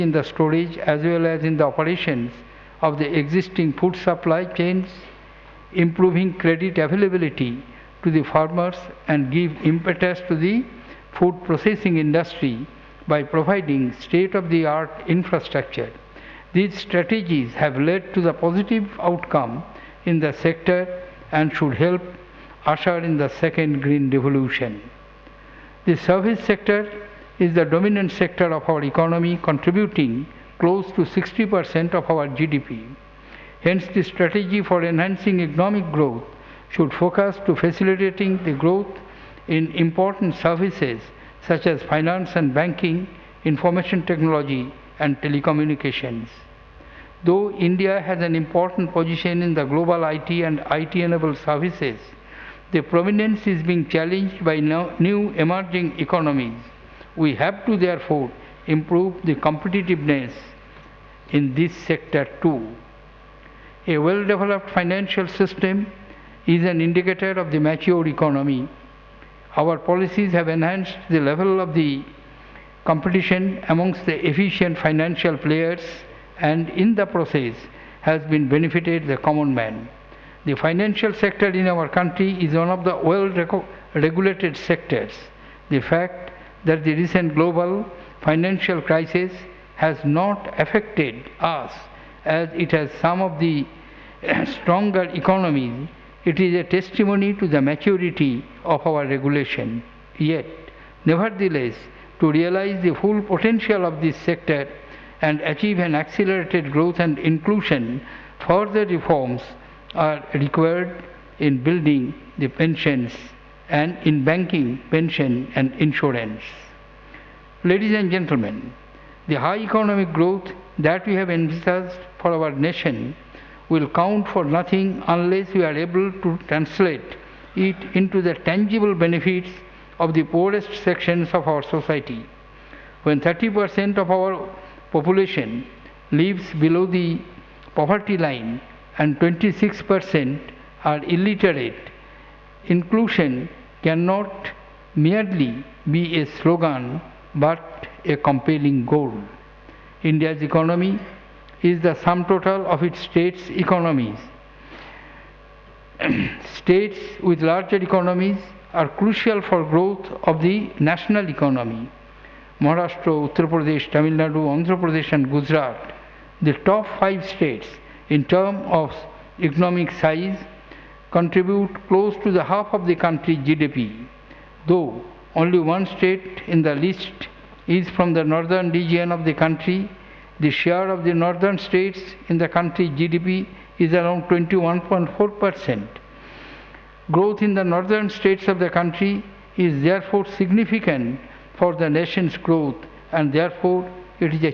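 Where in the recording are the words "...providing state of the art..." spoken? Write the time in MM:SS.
00:13.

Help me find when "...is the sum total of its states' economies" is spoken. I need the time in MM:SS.
02:31.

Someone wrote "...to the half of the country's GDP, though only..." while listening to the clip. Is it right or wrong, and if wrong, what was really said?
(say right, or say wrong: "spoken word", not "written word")
right.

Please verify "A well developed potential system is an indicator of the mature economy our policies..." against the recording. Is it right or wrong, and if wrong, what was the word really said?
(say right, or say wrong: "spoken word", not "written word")
wrong: "financial", not "potential".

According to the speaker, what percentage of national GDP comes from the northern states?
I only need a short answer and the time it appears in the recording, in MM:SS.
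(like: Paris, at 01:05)
21.4 percent, at 03:04.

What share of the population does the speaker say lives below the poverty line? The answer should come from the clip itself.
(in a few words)
30%.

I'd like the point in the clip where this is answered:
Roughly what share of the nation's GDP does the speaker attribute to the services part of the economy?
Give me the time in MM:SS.
00:30.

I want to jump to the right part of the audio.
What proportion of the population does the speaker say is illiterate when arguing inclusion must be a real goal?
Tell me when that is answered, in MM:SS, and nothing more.
02:19.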